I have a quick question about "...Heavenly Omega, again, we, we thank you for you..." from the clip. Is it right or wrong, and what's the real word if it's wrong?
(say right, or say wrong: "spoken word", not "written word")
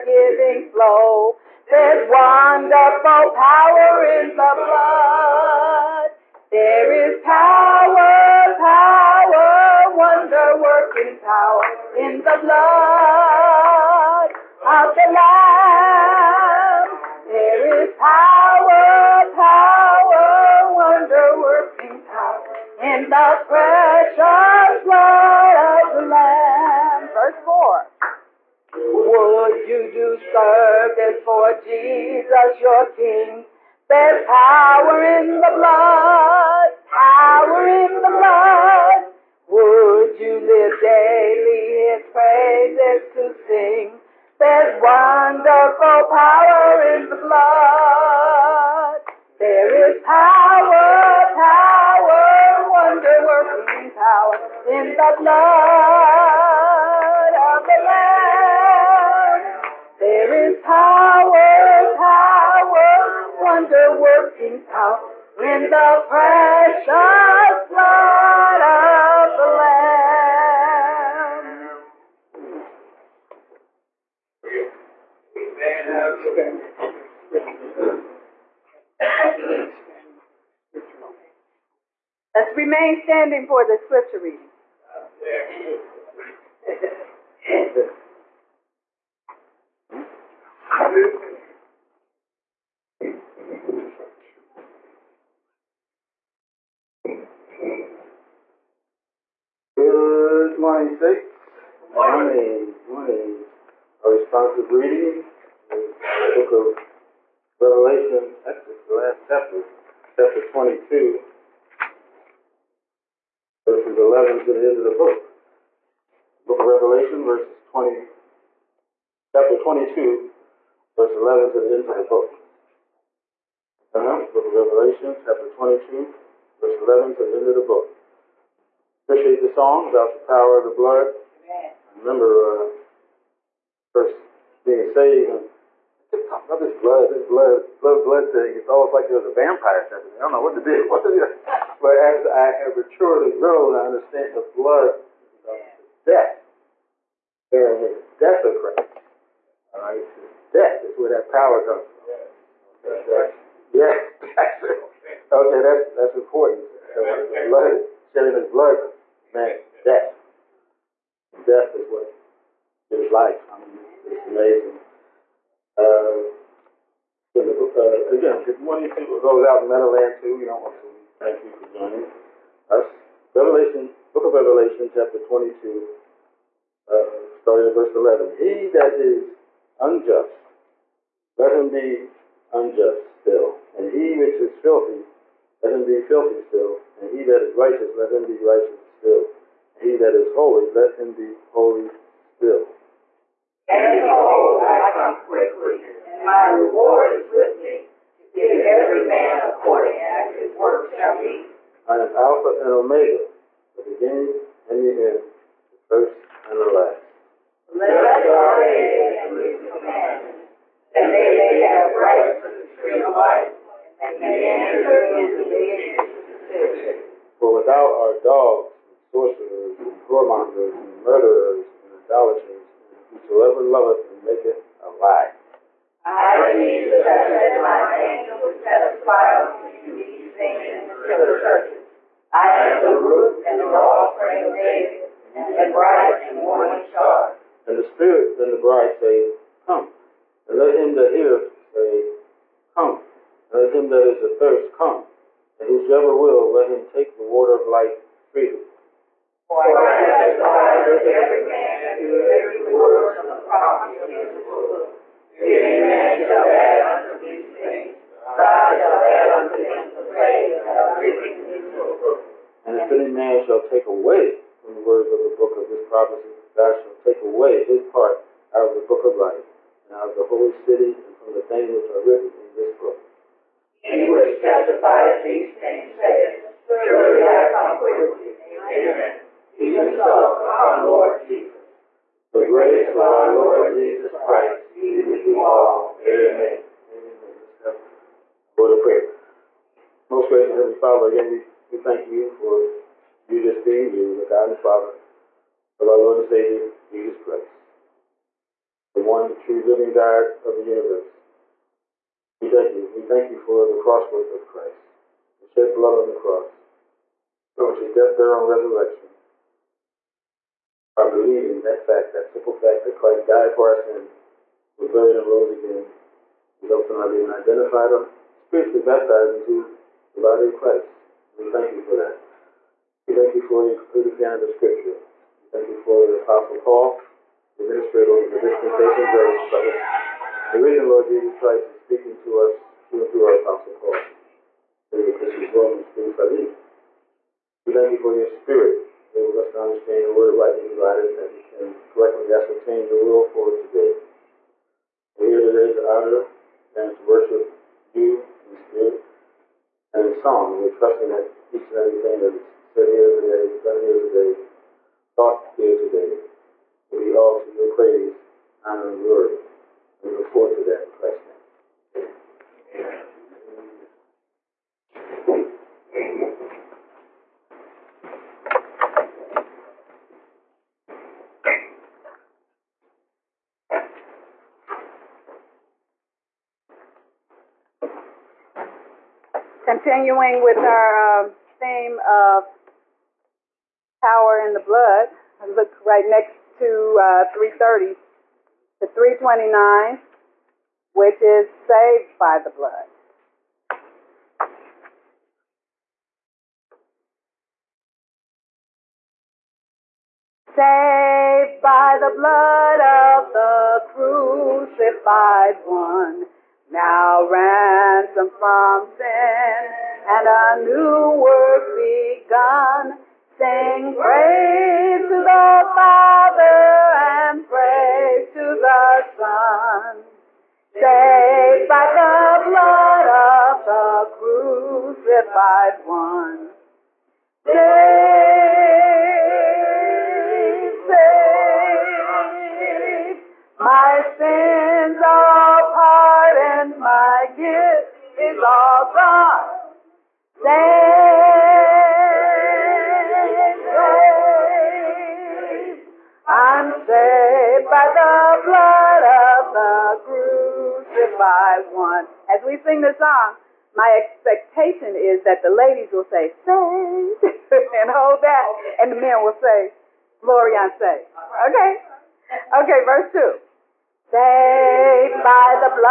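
wrong: "Father", not "Omega".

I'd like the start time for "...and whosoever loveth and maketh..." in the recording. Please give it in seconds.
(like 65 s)
222 s.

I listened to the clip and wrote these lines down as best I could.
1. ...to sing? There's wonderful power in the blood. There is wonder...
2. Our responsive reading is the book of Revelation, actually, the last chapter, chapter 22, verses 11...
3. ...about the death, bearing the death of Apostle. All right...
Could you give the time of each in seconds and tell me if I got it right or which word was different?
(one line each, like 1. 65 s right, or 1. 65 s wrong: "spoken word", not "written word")
1. 43 s wrong: "power", not "wonder"
2. 104 s right
3. 145 s wrong: "Christ", not "Apostle".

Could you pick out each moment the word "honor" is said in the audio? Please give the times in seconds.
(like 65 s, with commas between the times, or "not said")
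345 s, 358 s.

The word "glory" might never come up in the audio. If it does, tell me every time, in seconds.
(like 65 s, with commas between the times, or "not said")
359 s, 460 s.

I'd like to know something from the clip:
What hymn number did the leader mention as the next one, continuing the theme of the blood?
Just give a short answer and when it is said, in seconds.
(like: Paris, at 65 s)
329, at 388 s.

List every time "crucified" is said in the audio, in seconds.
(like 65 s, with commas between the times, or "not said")
403 s, 424 s, 450 s.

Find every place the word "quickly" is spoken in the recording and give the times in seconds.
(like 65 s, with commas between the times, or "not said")
195 s, 277 s.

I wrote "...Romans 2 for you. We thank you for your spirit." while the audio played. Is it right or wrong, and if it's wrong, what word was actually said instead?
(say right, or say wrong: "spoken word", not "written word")
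wrong: "3", not "2".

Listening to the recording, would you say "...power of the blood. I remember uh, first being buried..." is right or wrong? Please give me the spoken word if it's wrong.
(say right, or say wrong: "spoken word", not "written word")
wrong: "saved", not "buried".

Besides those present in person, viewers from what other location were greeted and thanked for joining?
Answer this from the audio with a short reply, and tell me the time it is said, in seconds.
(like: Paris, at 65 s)
Meadowland, at 169 s.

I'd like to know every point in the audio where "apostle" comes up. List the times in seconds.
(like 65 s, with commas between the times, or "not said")
326 s, 333 s.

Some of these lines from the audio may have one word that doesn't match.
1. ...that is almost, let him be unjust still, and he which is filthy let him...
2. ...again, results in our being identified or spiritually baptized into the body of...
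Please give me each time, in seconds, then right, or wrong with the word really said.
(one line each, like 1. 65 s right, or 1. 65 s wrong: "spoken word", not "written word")
1. 178 s wrong: "unjust", not "almost"
2. 315 s right.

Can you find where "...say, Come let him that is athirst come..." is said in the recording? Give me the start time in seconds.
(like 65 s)
241 s.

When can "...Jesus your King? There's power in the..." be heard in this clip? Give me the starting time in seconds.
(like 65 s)
31 s.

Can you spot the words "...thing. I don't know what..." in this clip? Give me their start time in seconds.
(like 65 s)
140 s.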